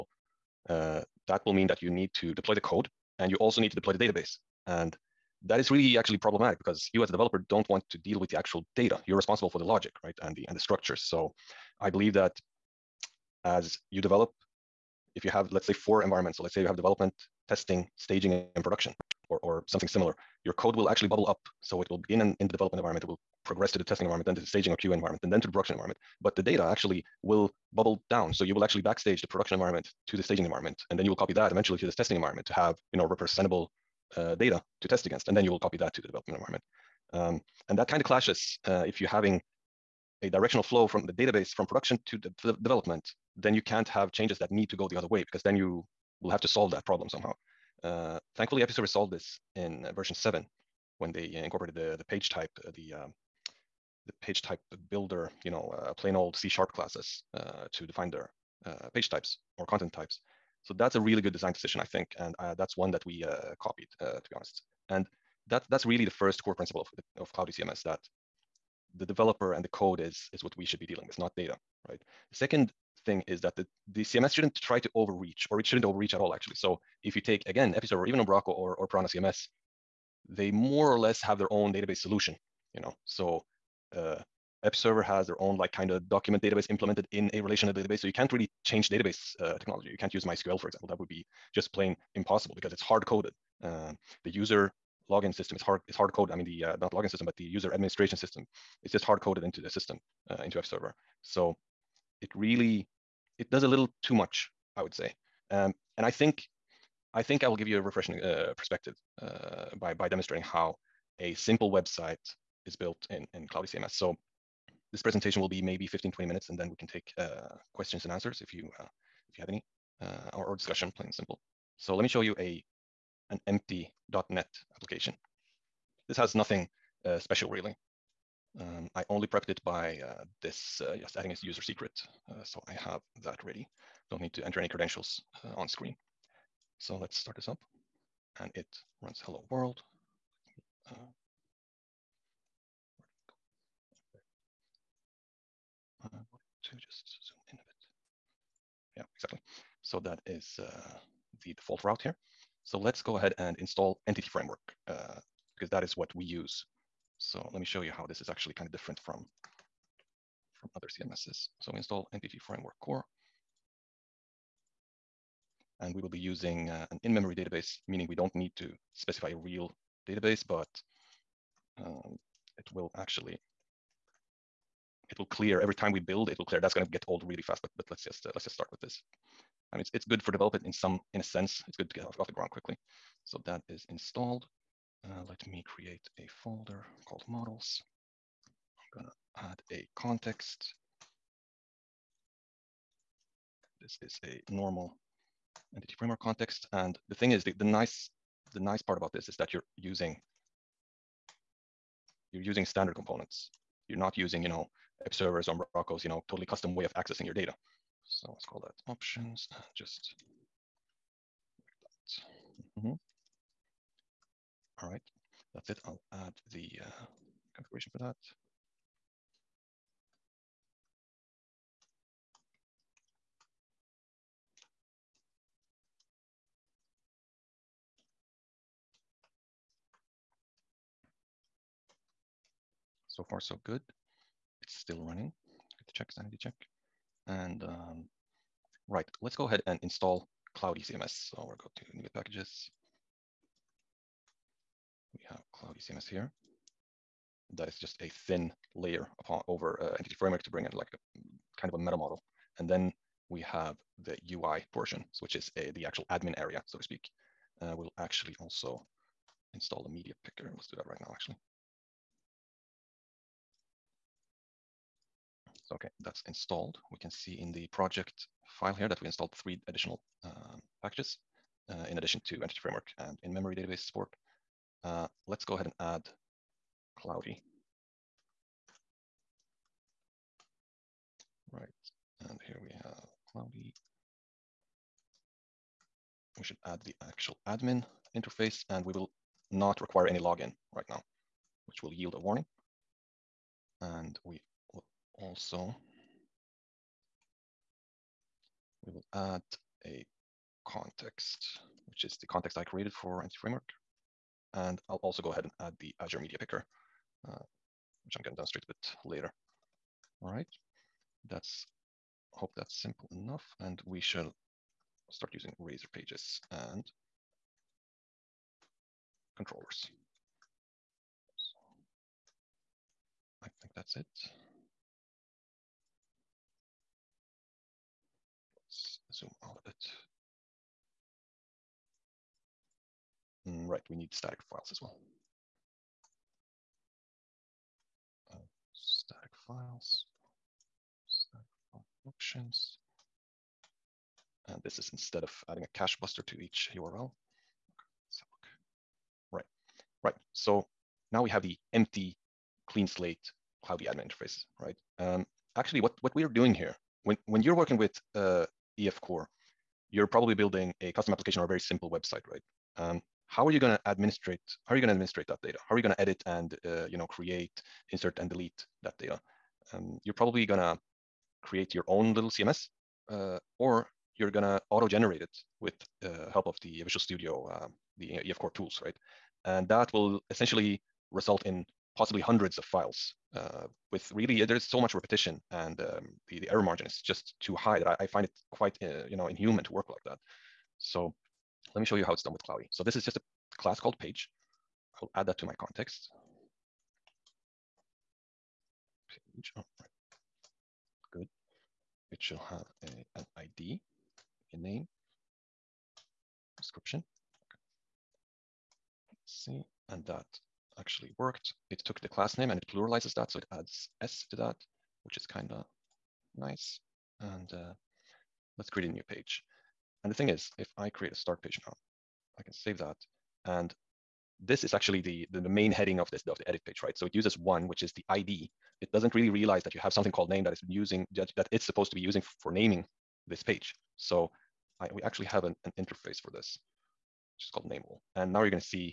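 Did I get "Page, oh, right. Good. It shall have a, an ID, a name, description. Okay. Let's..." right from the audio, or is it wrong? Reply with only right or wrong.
right.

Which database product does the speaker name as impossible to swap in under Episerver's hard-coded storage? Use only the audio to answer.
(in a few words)
MySQL.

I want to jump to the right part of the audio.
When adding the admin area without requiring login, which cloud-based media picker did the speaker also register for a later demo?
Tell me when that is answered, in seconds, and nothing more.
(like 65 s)
305 s.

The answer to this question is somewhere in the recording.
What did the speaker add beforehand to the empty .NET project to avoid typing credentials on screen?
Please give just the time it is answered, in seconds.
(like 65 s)
131 s.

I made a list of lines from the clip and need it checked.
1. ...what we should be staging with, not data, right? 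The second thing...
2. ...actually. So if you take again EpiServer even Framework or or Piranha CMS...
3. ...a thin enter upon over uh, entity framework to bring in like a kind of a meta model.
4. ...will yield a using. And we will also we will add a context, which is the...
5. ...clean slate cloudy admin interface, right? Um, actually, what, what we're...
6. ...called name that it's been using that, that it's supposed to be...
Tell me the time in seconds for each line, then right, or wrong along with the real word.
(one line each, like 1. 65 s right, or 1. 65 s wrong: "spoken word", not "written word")
1. 70 s wrong: "dealing", not "staging"
2. 76 s wrong: "Umbraco", not "Framework"
3. 248 s wrong: "layer", not "enter"
4. 291 s wrong: "warning", not "using"
5. 352 s right
6. 430 s right.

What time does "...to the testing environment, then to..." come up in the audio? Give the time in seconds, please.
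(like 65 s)
23 s.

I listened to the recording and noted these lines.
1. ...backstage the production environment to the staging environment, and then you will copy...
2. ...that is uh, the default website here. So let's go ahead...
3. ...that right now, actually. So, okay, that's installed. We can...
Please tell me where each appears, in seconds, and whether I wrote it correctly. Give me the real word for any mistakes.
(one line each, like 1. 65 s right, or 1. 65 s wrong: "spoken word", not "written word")
1. 28 s right
2. 149 s wrong: "route", not "website"
3. 260 s right.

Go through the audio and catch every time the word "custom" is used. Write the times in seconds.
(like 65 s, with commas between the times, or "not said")
206 s, 360 s.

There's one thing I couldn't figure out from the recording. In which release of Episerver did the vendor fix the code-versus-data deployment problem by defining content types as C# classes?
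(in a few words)
version 7.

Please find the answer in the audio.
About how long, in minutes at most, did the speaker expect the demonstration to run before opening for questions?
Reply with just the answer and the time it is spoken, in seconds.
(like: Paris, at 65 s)
20 minutes, at 116 s.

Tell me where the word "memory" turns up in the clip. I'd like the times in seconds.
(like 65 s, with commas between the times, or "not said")
167 s, 273 s.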